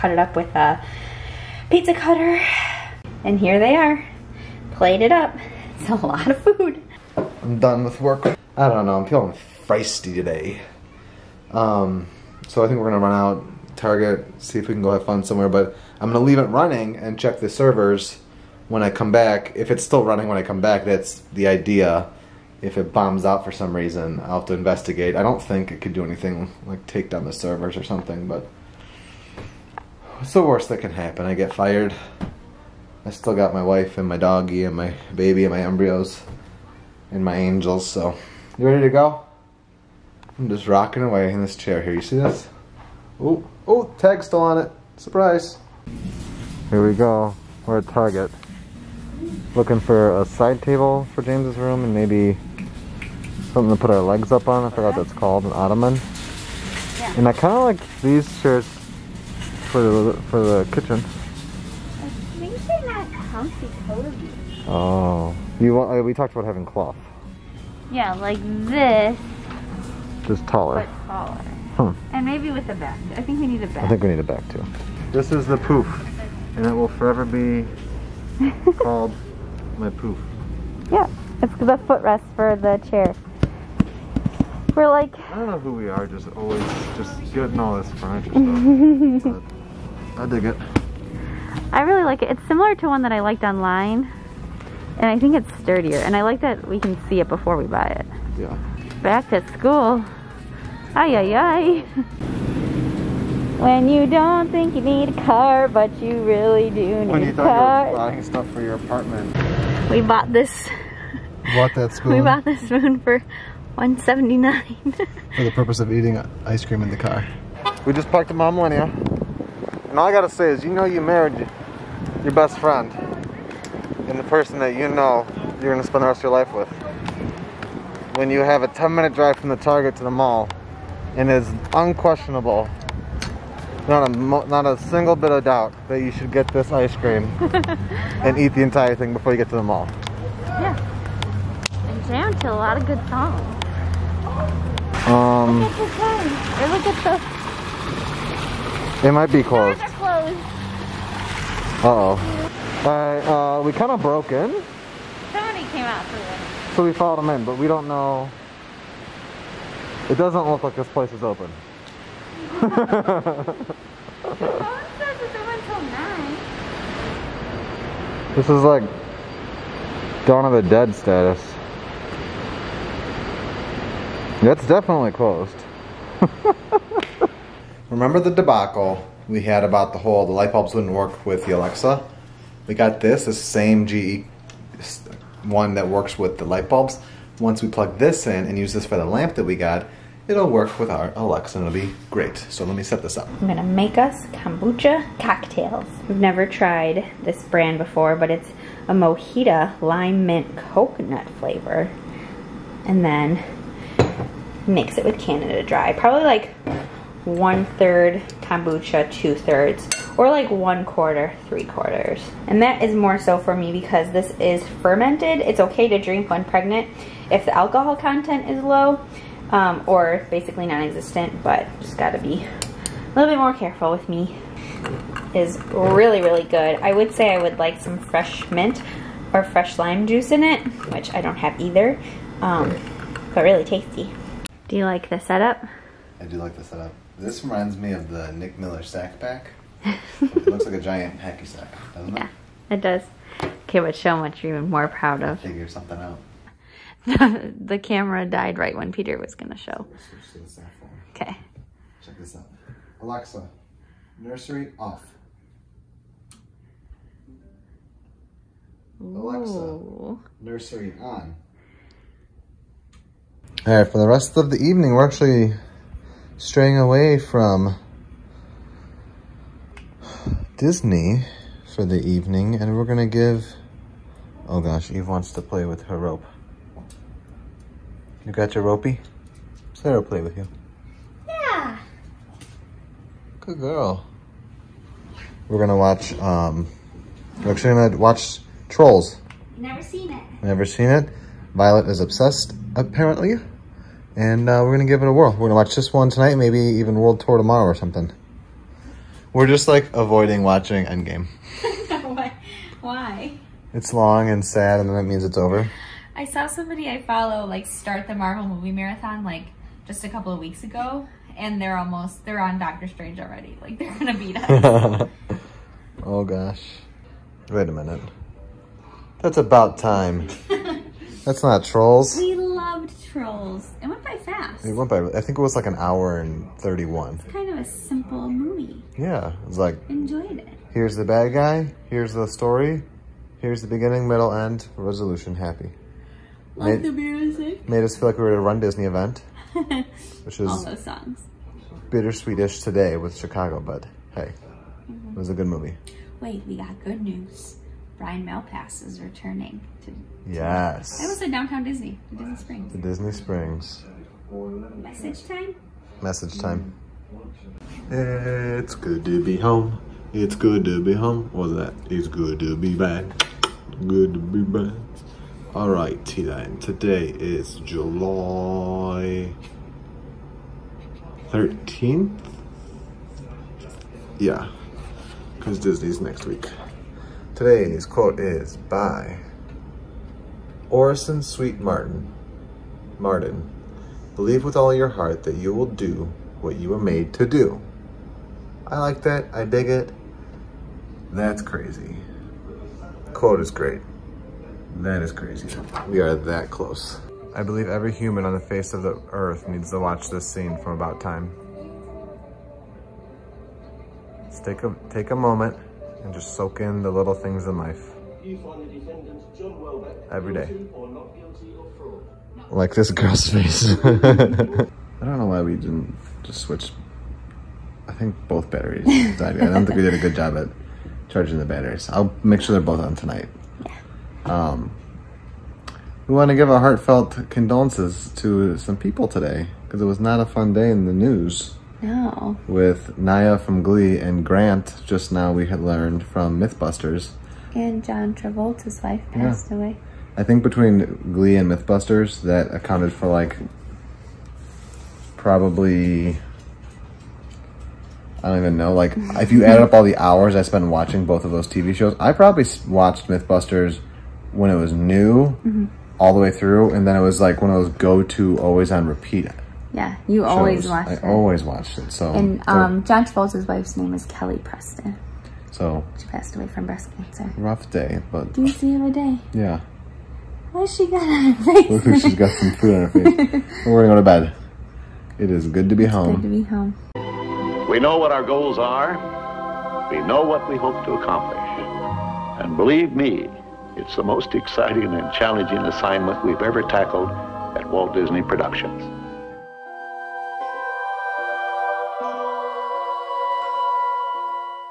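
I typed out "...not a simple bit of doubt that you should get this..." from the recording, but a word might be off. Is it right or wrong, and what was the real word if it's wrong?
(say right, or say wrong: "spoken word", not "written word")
wrong: "single", not "simple".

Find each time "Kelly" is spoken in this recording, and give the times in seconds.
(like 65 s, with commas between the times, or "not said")
464 s.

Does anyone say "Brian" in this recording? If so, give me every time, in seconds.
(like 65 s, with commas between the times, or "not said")
347 s.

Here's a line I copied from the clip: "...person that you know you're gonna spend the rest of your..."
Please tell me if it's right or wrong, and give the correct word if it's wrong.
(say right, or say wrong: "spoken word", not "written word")
right.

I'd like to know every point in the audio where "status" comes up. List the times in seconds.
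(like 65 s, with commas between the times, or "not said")
170 s.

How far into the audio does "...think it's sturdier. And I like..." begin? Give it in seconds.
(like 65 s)
95 s.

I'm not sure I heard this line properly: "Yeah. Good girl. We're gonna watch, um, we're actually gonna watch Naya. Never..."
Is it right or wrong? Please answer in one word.
wrong.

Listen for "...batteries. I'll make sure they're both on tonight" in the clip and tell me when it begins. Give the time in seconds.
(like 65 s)
421 s.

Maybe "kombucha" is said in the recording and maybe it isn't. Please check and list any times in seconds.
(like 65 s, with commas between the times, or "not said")
194 s, 208 s.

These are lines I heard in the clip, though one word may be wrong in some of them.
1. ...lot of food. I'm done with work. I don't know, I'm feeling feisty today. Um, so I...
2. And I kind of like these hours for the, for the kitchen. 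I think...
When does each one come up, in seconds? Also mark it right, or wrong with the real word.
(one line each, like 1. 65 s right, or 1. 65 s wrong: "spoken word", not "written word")
1. 5 s right
2. 57 s wrong: "chairs", not "hours".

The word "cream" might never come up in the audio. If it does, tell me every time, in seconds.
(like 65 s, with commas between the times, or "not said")
116 s, 136 s.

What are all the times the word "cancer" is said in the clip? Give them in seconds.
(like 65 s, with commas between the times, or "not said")
466 s.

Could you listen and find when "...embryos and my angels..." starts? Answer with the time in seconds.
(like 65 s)
35 s.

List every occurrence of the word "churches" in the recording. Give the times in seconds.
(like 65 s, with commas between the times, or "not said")
not said.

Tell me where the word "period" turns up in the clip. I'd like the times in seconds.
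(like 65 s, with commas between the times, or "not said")
not said.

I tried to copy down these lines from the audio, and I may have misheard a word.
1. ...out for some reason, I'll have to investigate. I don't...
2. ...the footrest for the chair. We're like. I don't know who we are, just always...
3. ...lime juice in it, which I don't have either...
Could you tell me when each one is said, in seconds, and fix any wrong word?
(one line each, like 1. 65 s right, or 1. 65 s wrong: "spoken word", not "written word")
1. 23 s right
2. 81 s right
3. 229 s right.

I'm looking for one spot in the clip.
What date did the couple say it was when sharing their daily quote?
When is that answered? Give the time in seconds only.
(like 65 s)
367 s.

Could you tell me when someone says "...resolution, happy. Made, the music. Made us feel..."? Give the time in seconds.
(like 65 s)
334 s.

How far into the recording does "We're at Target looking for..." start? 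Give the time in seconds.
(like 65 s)
47 s.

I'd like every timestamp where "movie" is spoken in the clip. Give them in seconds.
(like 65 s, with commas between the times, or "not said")
308 s, 328 s, 345 s.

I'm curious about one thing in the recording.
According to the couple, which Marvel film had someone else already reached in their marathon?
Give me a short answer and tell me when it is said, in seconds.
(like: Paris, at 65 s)
Doctor Strange, at 312 s.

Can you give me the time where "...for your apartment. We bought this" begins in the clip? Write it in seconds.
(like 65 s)
108 s.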